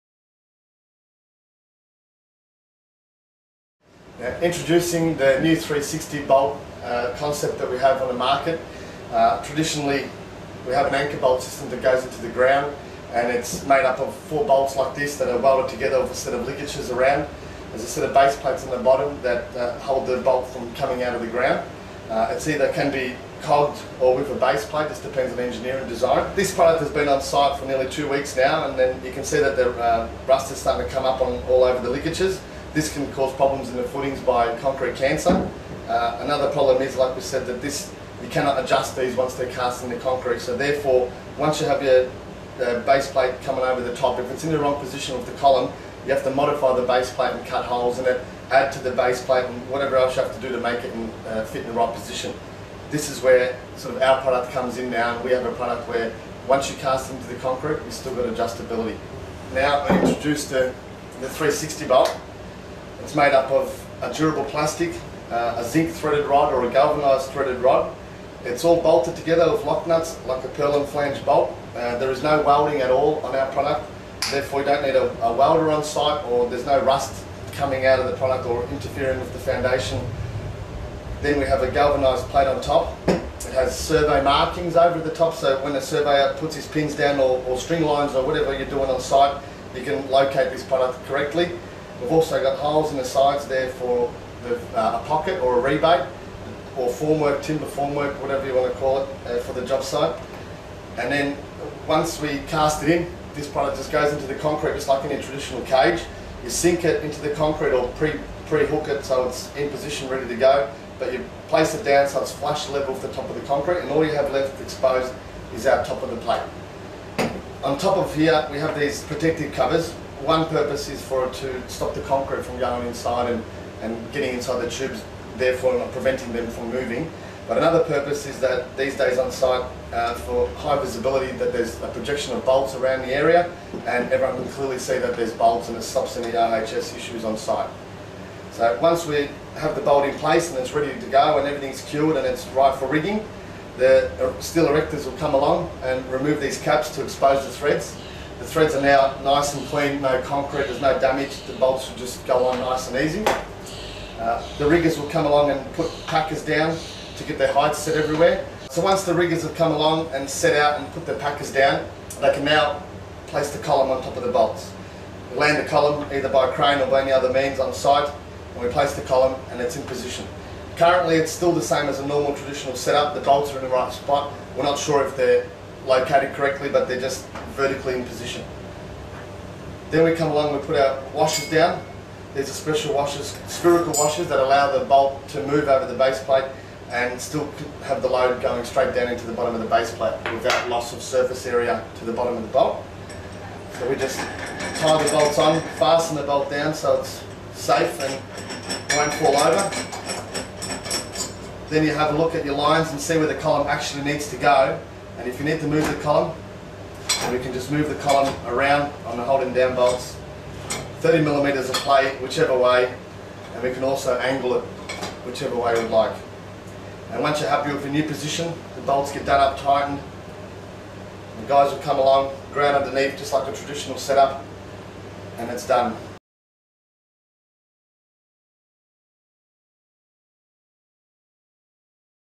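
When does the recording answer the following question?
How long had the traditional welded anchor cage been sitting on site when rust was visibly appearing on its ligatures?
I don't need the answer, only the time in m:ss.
0:27.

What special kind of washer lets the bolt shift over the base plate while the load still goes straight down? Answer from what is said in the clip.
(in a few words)
spherical washers.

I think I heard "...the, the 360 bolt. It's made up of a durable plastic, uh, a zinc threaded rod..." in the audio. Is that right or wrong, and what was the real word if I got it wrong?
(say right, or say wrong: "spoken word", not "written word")
right.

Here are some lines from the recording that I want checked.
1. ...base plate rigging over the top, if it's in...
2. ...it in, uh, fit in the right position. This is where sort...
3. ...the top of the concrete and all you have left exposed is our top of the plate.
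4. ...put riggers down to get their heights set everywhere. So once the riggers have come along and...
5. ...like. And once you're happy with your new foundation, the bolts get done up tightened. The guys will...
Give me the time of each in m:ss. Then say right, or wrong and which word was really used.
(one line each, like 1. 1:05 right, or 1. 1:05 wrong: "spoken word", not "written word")
1. 0:42 wrong: "coming", not "rigging"
2. 0:50 right
3. 1:53 right
4. 2:35 wrong: "packers", not "riggers"
5. 3:35 wrong: "position", not "foundation".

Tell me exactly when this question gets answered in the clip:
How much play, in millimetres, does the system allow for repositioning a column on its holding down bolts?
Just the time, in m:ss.
3:31.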